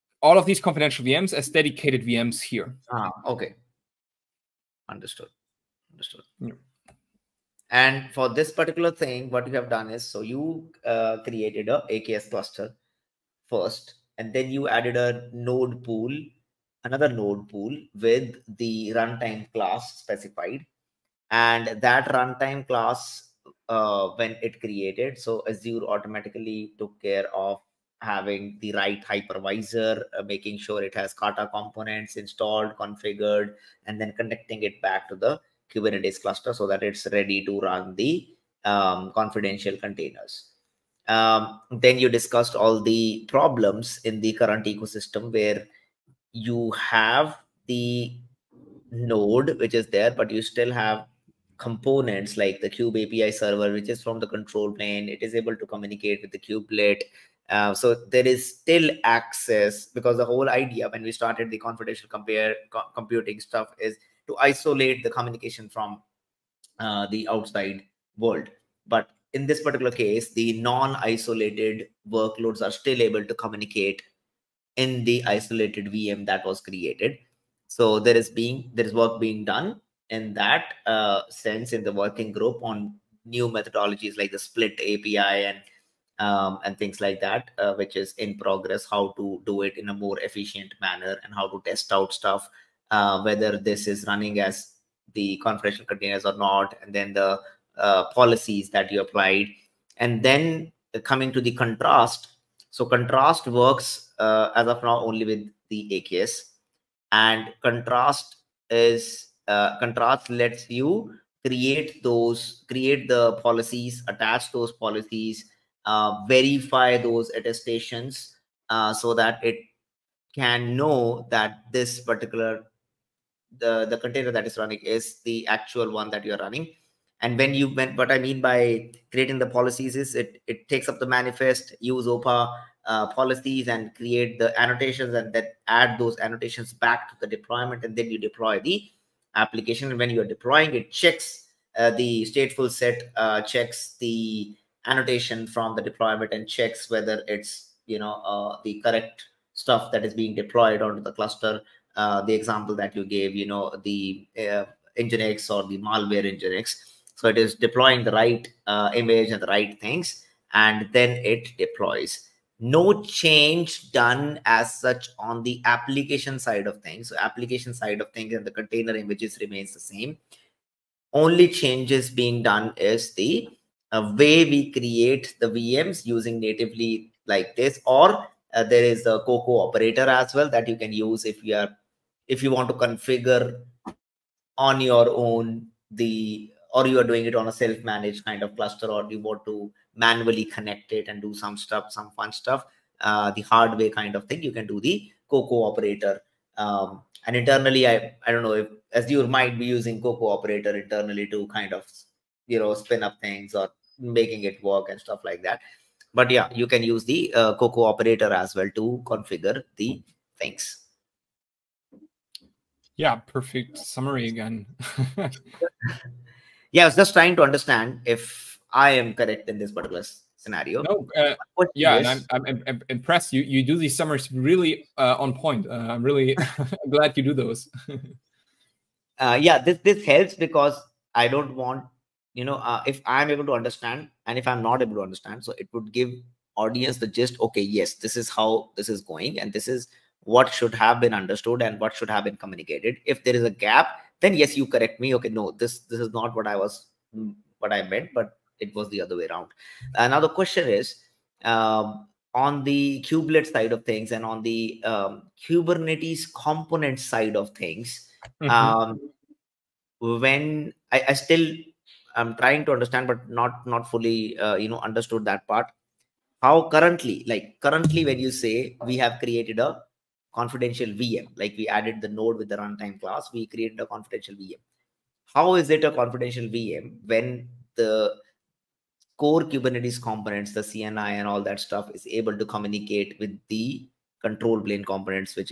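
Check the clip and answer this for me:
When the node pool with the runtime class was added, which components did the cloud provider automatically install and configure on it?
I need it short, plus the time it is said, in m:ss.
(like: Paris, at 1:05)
Kata components, at 0:31.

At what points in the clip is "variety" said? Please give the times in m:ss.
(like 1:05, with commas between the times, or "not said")
not said.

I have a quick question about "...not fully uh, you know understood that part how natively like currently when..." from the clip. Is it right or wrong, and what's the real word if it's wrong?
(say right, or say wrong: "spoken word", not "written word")
wrong: "currently", not "natively".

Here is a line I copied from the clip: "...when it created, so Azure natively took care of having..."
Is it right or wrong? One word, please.
wrong.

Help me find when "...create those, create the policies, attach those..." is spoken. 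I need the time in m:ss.
1:51.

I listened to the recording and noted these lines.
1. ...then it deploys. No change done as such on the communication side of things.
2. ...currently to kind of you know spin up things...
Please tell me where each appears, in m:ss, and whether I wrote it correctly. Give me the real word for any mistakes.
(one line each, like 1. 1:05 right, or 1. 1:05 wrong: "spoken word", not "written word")
1. 2:40 wrong: "application", not "communication"
2. 3:20 wrong: "internally", not "currently".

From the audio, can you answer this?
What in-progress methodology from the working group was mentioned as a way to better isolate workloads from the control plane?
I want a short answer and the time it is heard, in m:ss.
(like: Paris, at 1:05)
split API, at 1:24.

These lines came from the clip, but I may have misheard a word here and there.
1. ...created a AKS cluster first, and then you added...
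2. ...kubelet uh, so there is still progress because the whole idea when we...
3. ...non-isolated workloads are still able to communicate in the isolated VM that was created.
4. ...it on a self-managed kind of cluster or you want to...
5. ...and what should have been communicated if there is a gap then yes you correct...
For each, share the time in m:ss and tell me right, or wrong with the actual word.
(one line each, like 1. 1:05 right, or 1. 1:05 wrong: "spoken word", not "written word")
1. 0:11 right
2. 0:56 wrong: "access", not "progress"
3. 1:10 right
4. 3:07 right
5. 4:01 right.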